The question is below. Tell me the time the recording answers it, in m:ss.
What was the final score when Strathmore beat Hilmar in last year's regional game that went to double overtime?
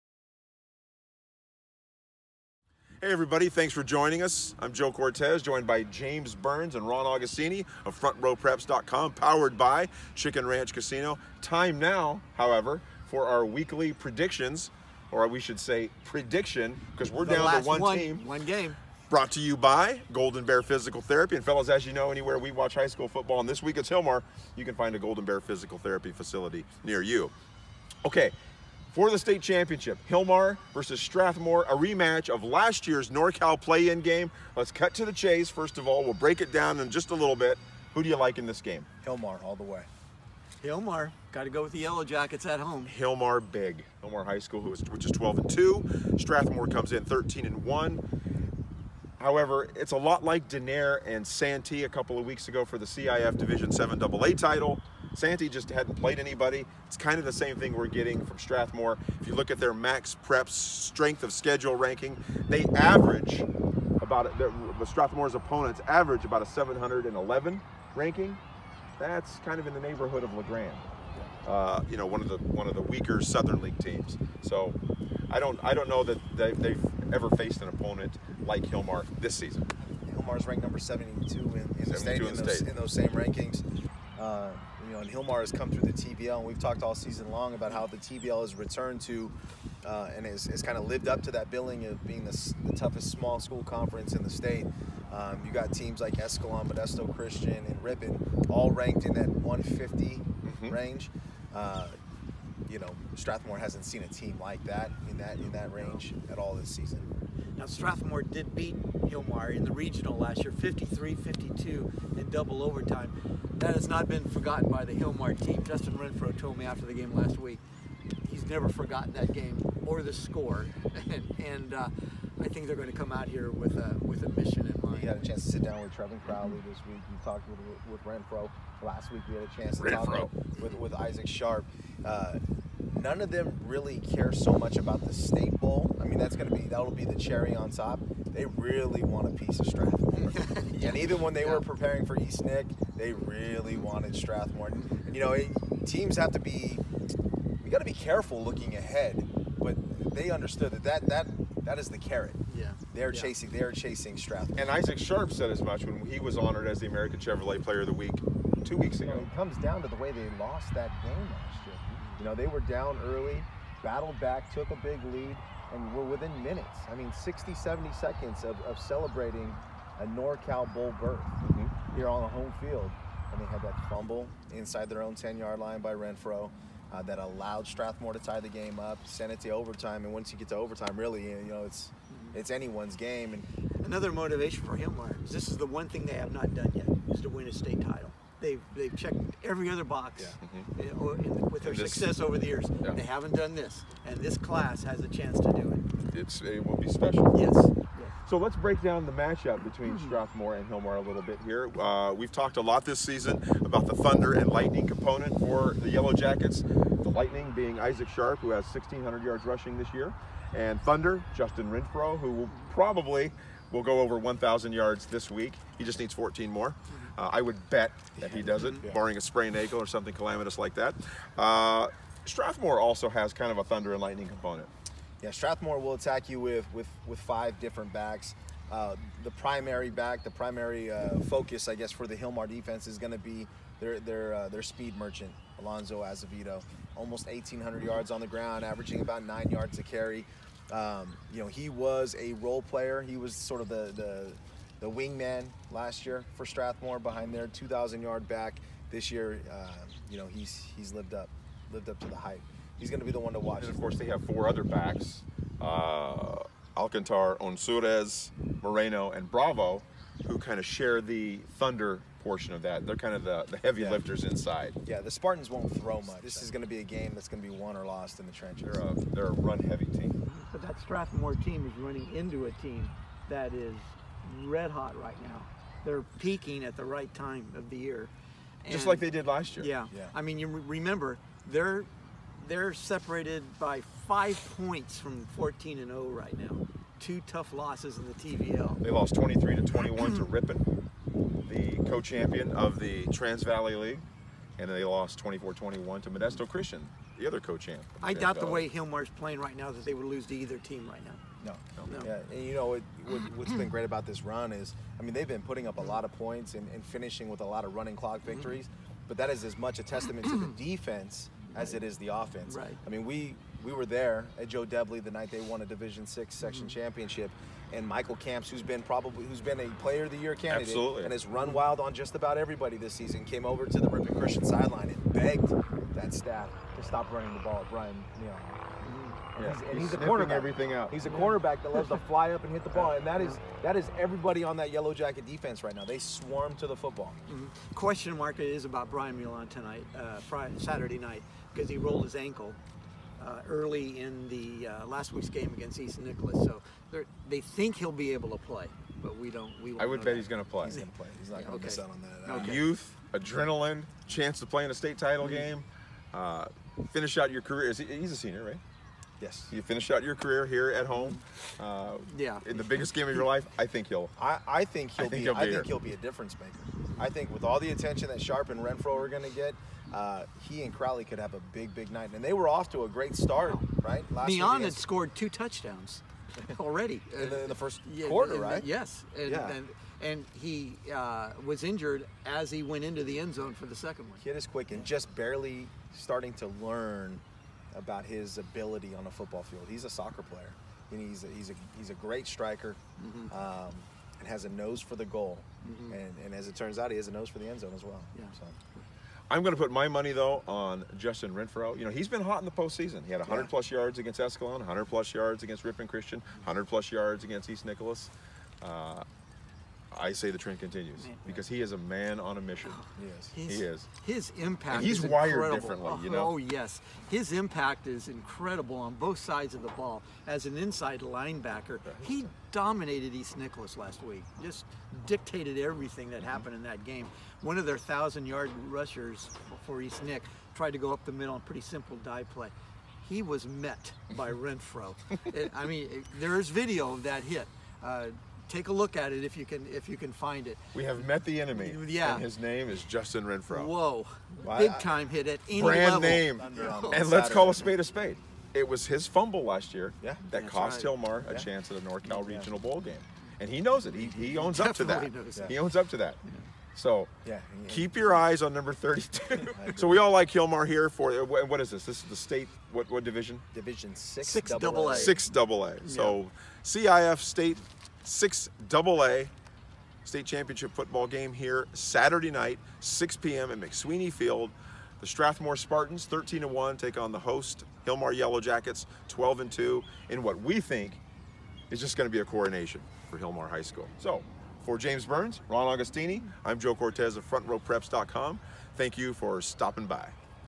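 1:50.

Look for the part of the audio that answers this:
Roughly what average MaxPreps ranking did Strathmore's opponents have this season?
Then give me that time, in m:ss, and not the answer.
1:06.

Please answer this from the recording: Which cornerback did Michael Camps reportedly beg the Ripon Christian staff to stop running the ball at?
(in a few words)
Brian Neal.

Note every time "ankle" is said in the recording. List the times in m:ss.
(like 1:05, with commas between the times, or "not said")
3:39, 5:42.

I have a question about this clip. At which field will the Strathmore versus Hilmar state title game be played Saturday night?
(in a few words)
McSweeney Field.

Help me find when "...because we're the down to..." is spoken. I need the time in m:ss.
0:16.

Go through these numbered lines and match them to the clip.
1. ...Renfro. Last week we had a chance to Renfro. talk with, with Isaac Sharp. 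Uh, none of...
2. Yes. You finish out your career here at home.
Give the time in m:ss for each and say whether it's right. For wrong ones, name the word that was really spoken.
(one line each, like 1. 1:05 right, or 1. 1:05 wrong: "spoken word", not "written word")
1. 2:08 right
2. 5:59 right.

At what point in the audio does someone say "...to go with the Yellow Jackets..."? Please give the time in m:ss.
0:41.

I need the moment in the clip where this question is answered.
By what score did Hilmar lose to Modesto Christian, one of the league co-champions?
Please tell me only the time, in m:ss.
4:55.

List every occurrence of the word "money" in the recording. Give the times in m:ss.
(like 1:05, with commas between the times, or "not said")
6:39.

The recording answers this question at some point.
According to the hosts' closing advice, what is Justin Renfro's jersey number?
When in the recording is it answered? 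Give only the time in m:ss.
7:38.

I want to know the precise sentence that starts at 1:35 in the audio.
Um, you got teams like Escalon, Modesto Christian, and Ripon, all ranked in that 150 mm-hmm.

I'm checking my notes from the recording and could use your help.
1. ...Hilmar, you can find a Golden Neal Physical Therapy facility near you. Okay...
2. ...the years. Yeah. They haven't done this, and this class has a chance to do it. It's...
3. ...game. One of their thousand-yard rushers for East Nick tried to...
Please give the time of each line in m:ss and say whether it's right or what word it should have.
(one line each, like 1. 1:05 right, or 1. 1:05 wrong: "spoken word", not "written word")
1. 0:23 wrong: "Bear", not "Neal"
2. 3:12 right
3. 7:06 right.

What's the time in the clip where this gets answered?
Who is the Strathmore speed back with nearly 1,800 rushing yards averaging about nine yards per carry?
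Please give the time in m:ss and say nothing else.
3:55.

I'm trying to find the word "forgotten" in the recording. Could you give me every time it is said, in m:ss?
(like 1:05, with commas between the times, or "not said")
1:54, 1:58.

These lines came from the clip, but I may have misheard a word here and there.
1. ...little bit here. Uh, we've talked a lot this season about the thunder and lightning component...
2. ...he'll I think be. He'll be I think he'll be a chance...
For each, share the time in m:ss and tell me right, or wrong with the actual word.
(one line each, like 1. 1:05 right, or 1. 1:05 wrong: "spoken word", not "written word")
1. 3:21 right
2. 6:04 wrong: "difference", not "chance".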